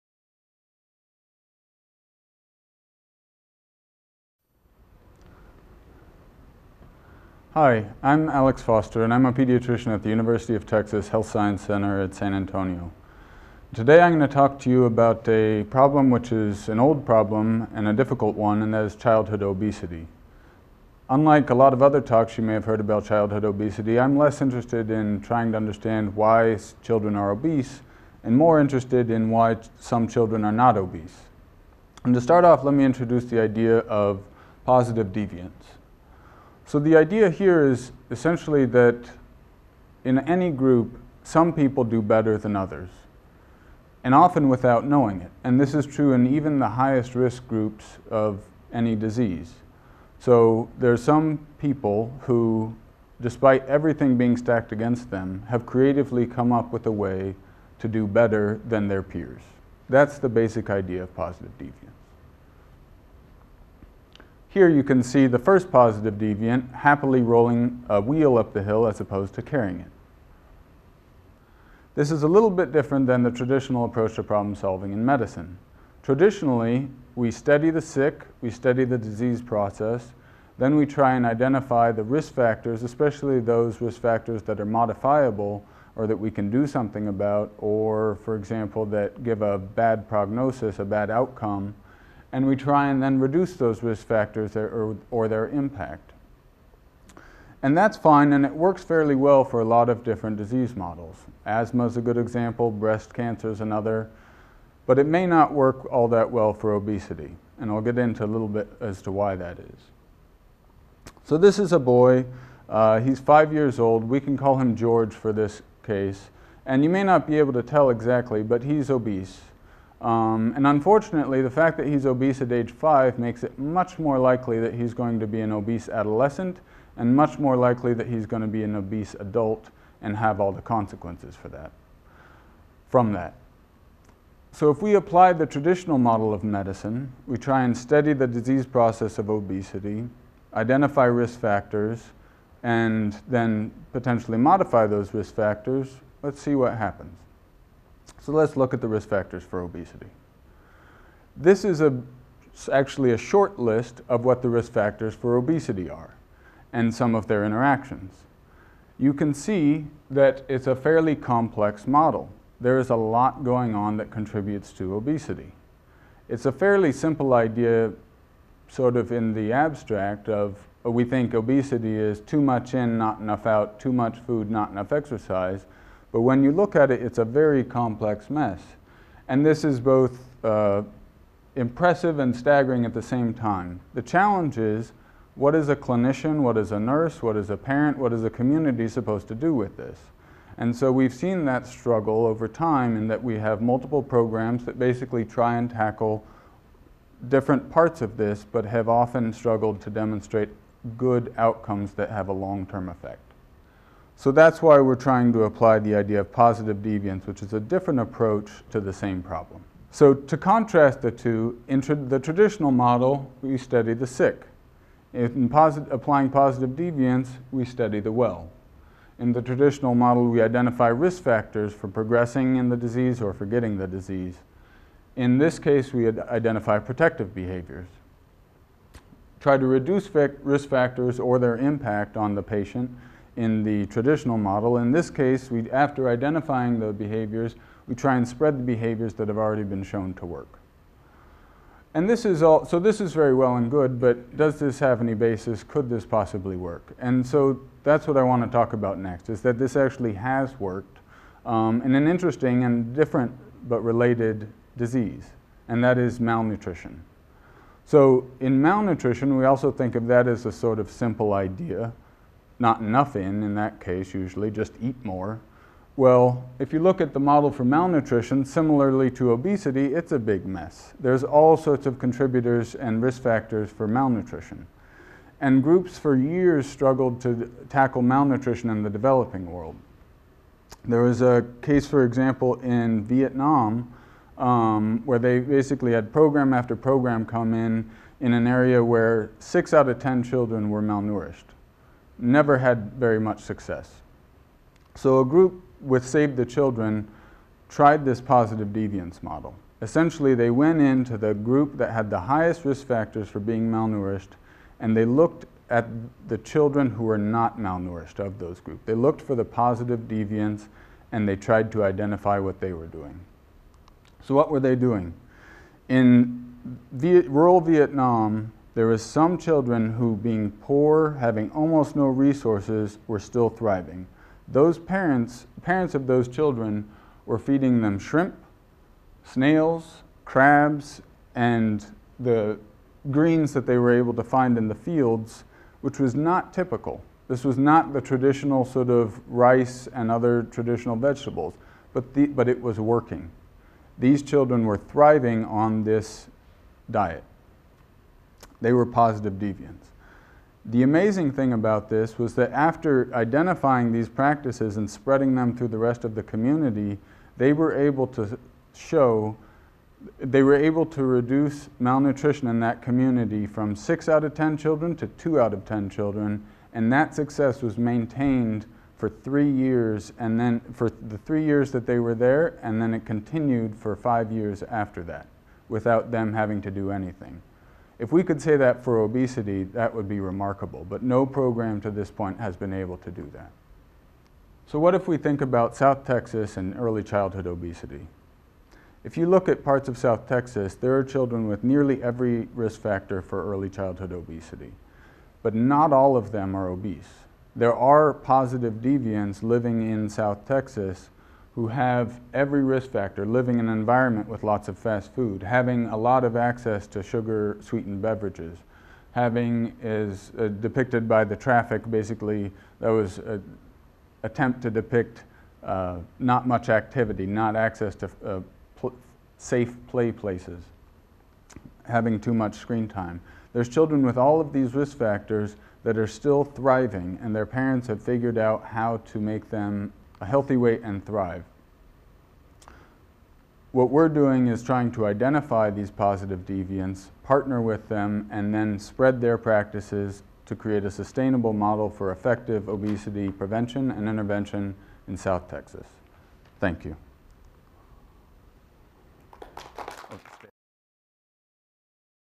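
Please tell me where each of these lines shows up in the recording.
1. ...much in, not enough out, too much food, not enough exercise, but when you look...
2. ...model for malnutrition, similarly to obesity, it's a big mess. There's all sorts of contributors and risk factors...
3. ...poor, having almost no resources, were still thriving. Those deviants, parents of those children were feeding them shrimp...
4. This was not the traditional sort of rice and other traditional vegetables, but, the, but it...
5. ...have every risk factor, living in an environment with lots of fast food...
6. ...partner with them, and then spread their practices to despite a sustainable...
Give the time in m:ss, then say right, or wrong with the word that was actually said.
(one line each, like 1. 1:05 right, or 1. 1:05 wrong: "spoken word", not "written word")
1. 2:52 right
2. 4:27 right
3. 5:20 wrong: "parents", not "deviants"
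4. 5:37 right
5. 6:41 right
6. 7:17 wrong: "create", not "despite".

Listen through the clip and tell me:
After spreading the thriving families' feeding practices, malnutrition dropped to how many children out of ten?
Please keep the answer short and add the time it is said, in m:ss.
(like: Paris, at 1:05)
2, at 6:05.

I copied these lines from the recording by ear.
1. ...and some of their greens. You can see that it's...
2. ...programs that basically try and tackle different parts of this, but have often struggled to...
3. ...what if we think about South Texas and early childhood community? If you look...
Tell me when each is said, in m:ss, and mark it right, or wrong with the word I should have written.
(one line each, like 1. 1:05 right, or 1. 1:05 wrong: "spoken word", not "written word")
1. 2:36 wrong: "interactions", not "greens"
2. 3:14 right
3. 6:24 wrong: "obesity", not "community".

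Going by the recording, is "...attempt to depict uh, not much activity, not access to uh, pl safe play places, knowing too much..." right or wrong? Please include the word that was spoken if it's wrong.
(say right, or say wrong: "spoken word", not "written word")
wrong: "having", not "knowing".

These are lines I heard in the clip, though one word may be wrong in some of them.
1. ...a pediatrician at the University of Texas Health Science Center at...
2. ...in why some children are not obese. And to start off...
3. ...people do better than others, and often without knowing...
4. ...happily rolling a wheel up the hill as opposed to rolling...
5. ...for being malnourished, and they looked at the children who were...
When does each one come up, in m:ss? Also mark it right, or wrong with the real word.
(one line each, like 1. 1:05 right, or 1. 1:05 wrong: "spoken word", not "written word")
1. 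0:09 right
2. 0:29 right
3. 0:41 right
4. 1:06 wrong: "carrying", not "rolling"
5. 5:03 right.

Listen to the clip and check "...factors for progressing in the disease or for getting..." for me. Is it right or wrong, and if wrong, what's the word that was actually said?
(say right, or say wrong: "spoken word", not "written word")
right.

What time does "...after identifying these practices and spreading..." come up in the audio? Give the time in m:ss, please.
5:52.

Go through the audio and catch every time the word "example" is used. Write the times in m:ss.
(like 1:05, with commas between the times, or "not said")
1:28, 1:42, 4:42.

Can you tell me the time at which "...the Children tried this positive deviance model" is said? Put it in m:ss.
4:56.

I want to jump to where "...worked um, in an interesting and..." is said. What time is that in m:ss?
4:10.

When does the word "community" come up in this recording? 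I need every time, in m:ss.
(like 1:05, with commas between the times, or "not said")
3:08, 5:56, 6:02.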